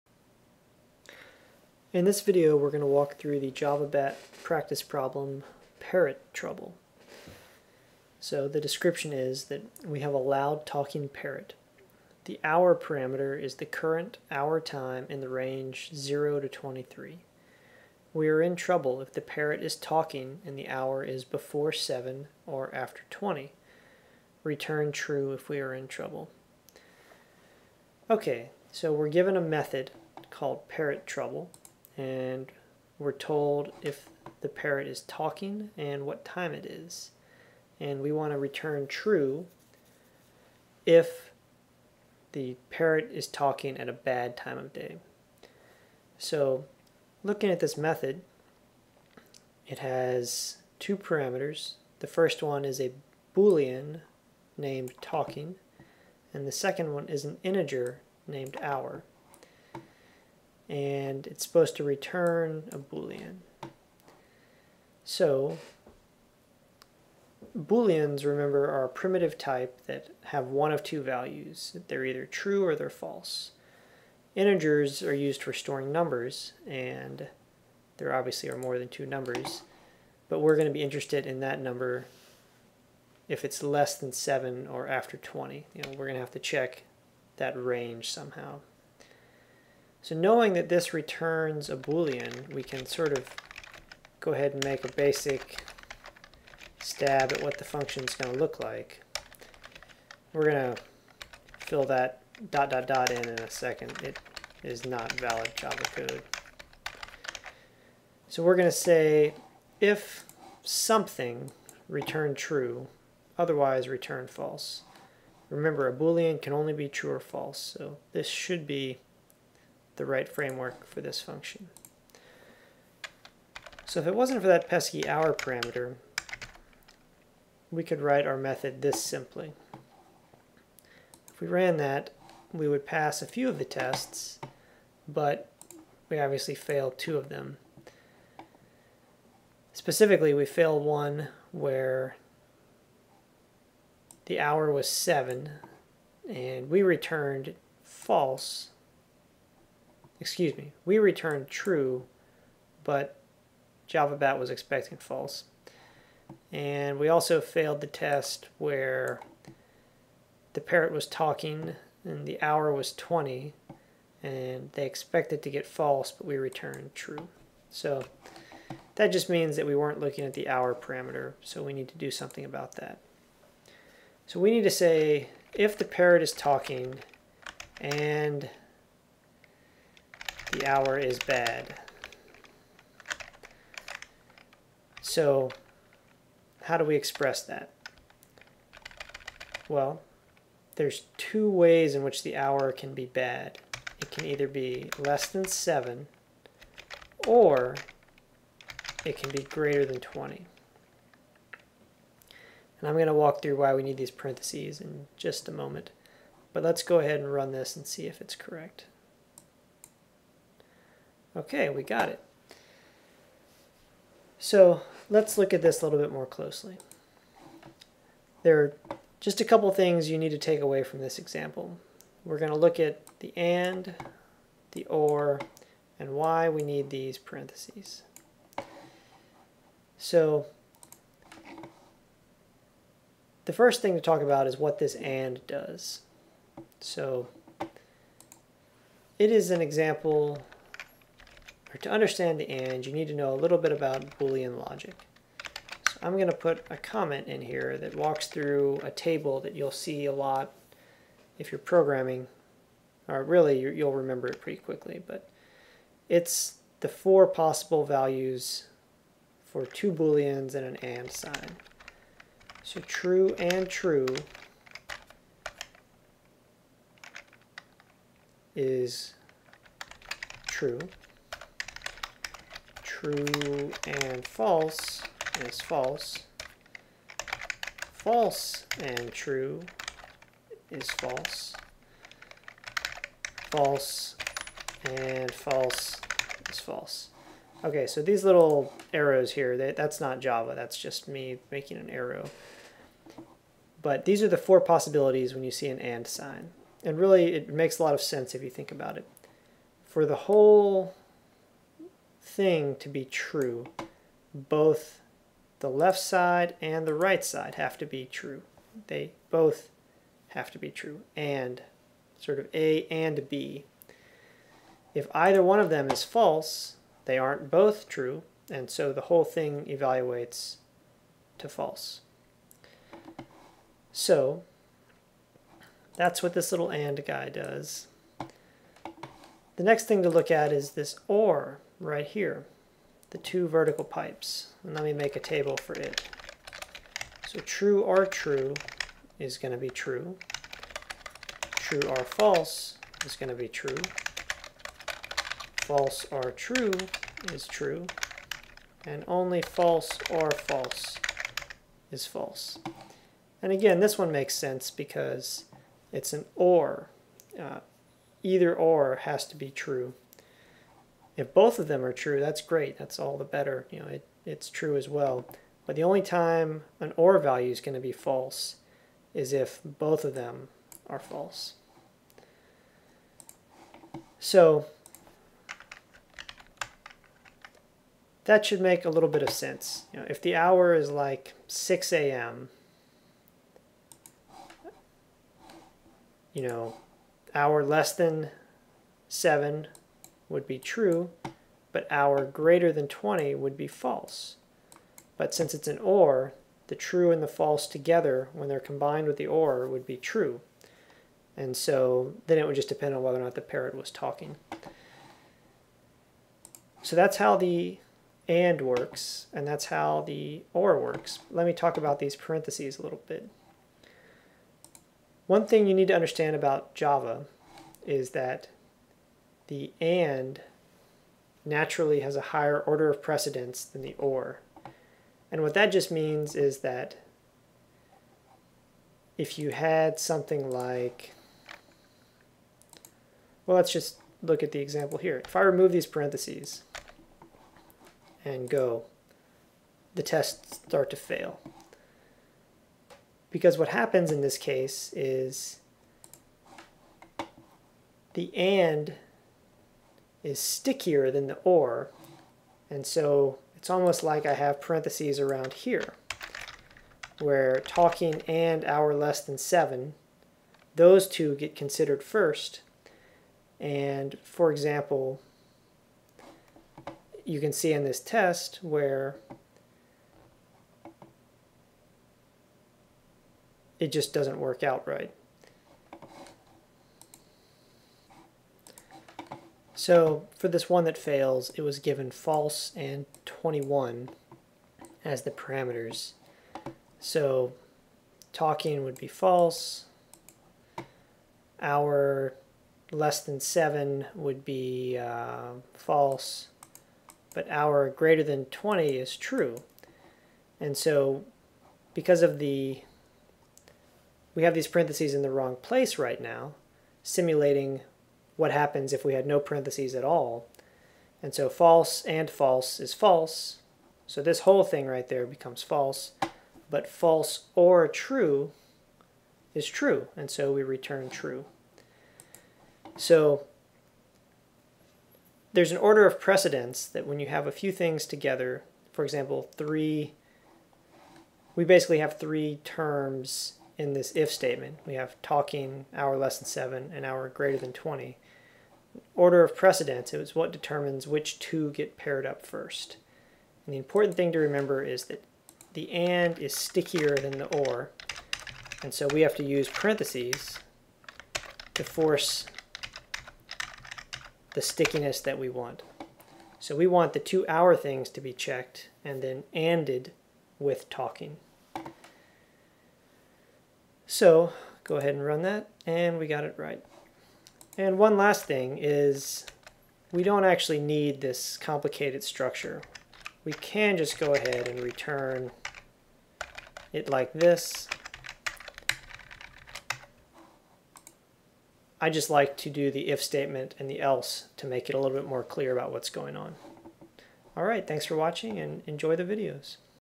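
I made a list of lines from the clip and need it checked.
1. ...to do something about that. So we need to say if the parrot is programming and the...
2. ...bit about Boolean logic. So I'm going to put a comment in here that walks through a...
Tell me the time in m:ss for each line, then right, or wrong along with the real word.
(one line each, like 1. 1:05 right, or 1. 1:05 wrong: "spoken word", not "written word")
1. 2:51 wrong: "talking", not "programming"
2. 4:03 right.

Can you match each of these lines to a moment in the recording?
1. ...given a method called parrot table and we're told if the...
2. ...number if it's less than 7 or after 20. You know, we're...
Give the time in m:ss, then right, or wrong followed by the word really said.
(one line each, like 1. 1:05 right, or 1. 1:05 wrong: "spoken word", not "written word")
1. 0:29 wrong: "trouble", not "table"
2. 1:21 right.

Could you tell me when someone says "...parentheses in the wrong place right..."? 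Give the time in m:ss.
8:24.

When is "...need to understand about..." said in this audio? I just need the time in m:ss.
6:55.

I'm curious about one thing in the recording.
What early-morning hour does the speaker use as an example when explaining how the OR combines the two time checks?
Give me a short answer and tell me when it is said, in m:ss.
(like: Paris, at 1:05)
6 a.m., at 6:21.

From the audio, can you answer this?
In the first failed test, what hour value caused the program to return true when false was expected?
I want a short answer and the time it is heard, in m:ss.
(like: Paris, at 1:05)
7, at 2:24.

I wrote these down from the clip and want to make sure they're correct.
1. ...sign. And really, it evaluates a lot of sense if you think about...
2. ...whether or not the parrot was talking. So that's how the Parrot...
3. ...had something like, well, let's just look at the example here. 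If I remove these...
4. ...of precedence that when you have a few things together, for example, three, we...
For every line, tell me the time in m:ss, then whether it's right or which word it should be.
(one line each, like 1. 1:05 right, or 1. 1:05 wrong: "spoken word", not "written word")
1. 4:56 wrong: "makes", not "evaluates"
2. 6:43 wrong: "AND", not "Parrot"
3. 7:09 right
4. 8:46 right.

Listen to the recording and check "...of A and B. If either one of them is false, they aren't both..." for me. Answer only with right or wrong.
right.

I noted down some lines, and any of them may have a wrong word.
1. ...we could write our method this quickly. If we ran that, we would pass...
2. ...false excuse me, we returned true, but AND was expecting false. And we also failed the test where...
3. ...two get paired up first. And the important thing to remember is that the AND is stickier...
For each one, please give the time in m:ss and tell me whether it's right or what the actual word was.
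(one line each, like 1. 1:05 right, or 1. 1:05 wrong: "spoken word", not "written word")
1. 2:07 wrong: "simply", not "quickly"
2. 2:27 wrong: "JavaBat", not "AND"
3. 9:01 right.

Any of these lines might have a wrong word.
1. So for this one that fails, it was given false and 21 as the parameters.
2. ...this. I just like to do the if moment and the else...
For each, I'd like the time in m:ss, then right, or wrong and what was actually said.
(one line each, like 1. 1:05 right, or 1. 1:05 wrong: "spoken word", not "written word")
1. 7:59 right
2. 9:37 wrong: "statement", not "moment".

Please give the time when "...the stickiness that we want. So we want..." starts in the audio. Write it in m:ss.
9:14.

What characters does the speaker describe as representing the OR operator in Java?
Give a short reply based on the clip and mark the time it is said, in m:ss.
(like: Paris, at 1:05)
two vertical pipes, at 5:33.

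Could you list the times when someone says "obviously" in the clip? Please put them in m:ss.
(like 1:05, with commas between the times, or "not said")
1:18, 2:16.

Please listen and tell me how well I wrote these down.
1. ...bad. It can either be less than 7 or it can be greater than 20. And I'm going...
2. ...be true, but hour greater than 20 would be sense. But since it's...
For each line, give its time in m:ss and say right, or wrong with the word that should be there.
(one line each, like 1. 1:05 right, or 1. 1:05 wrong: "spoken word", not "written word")
1. 3:13 right
2. 6:30 wrong: "false", not "sense".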